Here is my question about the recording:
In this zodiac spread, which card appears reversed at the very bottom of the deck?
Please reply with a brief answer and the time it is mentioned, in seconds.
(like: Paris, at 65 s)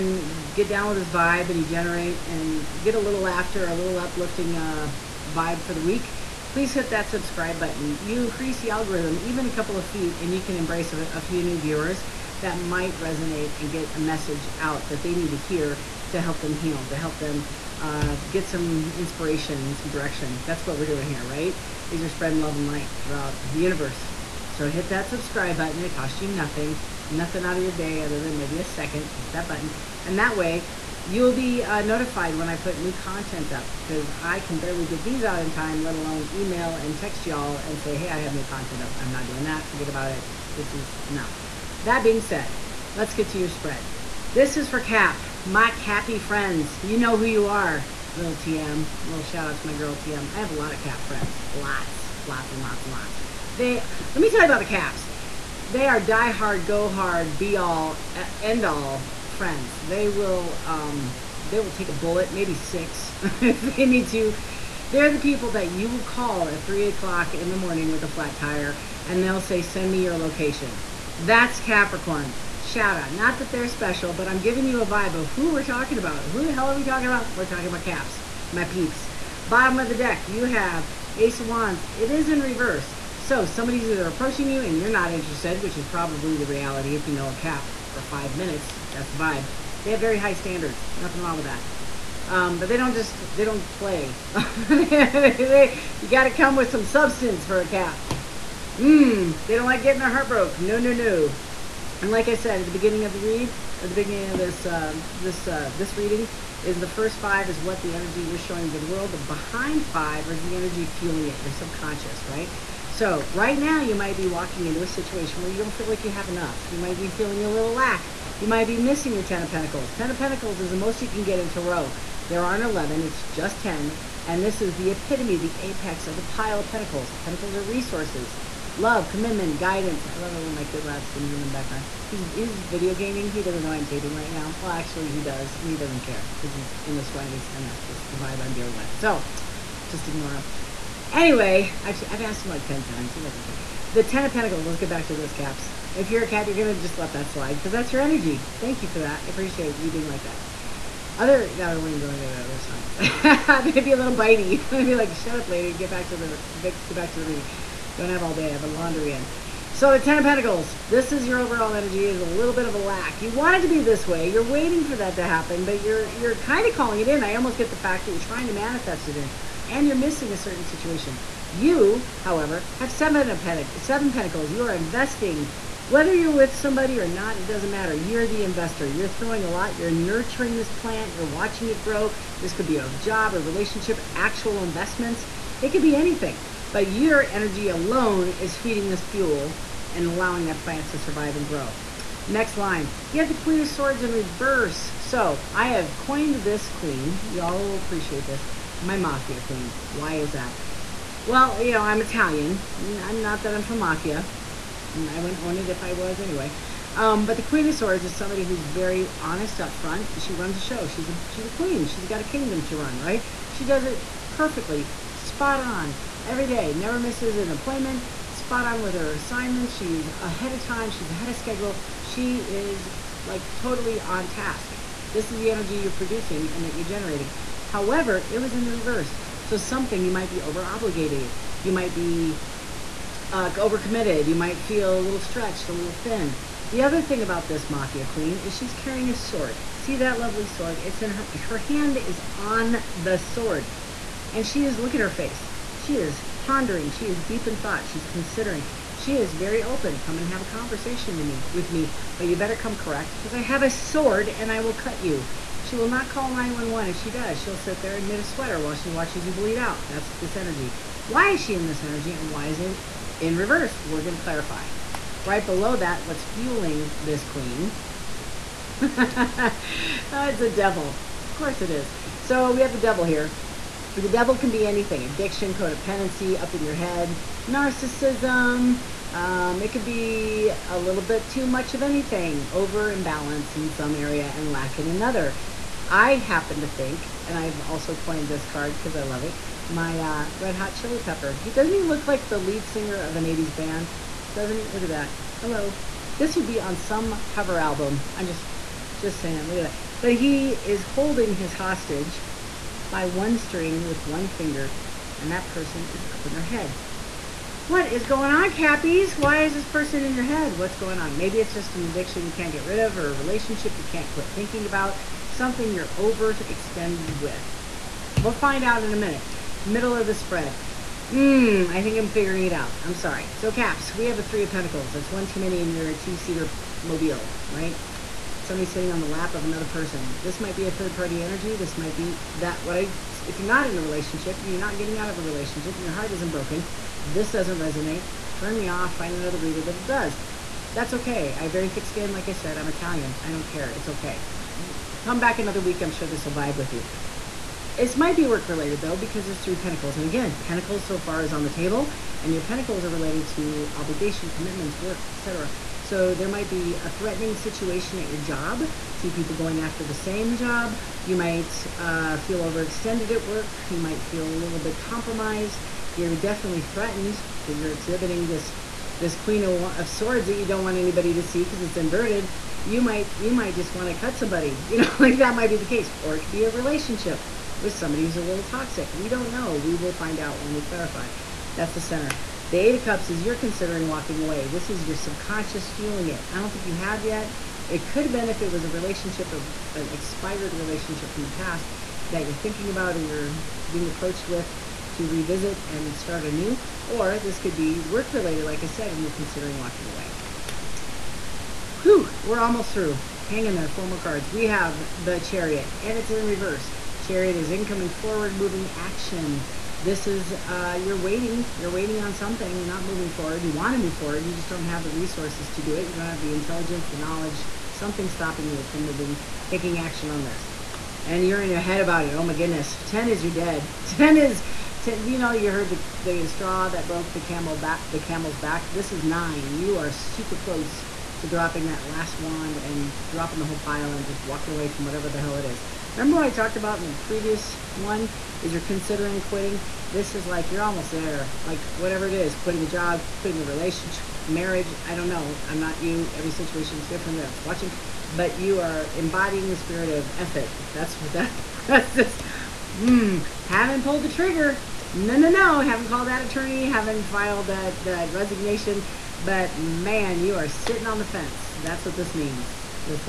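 Ace of Wands, at 81 s.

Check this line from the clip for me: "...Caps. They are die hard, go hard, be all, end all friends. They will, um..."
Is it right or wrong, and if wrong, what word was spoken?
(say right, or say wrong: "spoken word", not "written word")
right.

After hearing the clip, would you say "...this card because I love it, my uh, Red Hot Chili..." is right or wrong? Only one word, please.
right.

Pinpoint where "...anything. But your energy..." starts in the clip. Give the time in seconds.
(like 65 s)
185 s.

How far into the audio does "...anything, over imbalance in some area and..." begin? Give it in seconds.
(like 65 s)
281 s.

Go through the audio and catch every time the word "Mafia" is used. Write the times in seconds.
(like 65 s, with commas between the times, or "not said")
198 s, 203 s, 237 s.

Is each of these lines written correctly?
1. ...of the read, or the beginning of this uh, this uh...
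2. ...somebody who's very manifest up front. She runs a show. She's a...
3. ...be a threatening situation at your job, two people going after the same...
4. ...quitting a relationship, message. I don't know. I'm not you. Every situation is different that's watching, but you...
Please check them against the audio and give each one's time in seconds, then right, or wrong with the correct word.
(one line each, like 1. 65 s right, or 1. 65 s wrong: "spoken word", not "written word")
1. 103 s right
2. 208 s wrong: "honest", not "manifest"
3. 356 s right
4. 443 s wrong: "marriage", not "message".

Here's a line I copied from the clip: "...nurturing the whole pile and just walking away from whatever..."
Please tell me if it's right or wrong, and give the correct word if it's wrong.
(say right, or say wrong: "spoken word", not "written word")
wrong: "dropping", not "nurturing".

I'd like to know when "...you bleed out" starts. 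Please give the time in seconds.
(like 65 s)
259 s.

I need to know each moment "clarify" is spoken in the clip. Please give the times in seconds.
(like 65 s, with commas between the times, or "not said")
264 s, 380 s.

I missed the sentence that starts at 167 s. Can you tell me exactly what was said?
I almost get the fact that you're trying to manifest it in, and you're missing a certain situation.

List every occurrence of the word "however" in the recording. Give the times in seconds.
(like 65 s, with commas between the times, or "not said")
172 s, 227 s.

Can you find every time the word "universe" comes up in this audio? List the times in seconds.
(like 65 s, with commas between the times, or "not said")
23 s.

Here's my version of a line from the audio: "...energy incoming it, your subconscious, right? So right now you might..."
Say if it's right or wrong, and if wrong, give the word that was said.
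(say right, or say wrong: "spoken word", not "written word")
wrong: "fueling", not "incoming".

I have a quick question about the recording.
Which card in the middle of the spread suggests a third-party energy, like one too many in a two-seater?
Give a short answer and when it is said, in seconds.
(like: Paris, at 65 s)
Three of Pentacles, at 324 s.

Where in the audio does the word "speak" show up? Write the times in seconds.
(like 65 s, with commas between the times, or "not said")
not said.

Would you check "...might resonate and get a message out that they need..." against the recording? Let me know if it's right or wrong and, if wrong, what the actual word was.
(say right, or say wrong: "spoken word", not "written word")
right.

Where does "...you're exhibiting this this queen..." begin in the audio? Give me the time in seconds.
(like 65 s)
367 s.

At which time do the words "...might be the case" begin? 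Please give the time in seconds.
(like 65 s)
375 s.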